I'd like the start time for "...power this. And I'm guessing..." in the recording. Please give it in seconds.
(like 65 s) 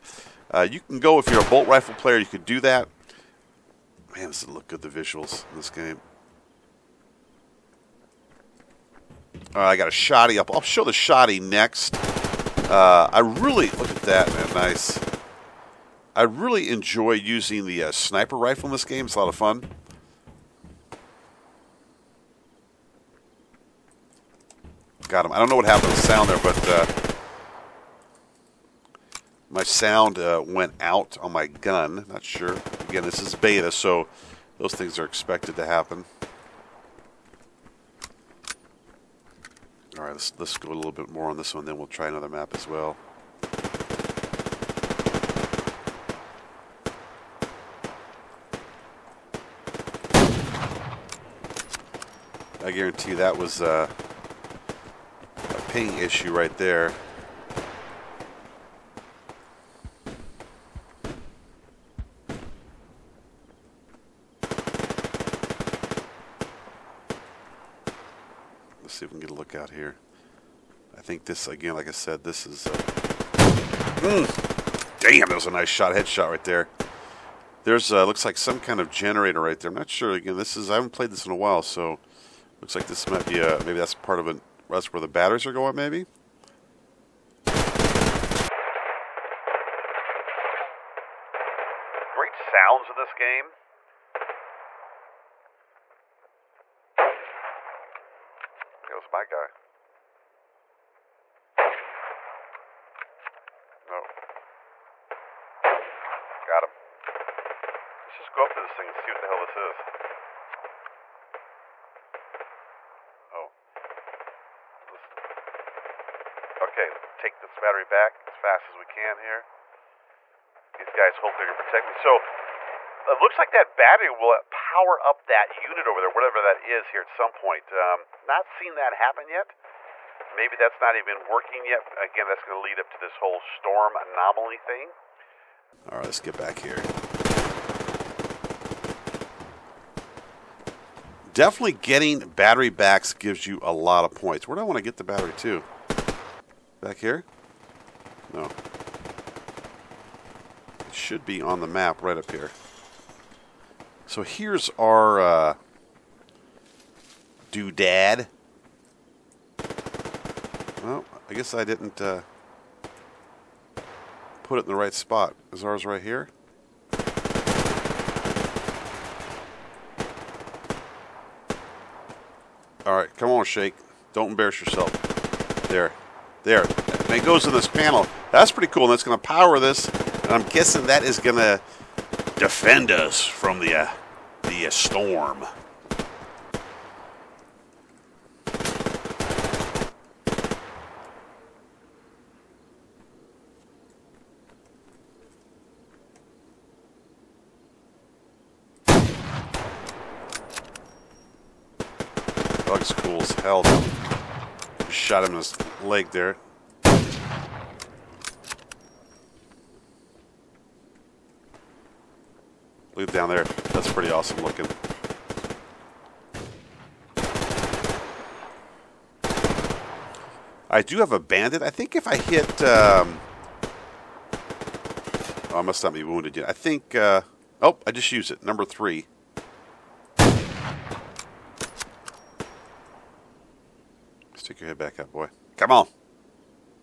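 179 s.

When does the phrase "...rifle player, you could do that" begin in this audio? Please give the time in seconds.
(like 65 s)
1 s.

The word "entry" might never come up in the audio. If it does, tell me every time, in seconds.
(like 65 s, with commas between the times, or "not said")
not said.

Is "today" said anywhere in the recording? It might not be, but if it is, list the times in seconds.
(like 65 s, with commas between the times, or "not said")
not said.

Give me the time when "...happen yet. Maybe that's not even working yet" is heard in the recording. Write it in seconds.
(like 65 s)
128 s.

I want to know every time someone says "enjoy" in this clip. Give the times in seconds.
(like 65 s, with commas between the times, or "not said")
16 s.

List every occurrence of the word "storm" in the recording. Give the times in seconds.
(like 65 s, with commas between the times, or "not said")
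133 s, 184 s.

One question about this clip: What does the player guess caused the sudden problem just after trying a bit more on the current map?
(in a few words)
Ping issue.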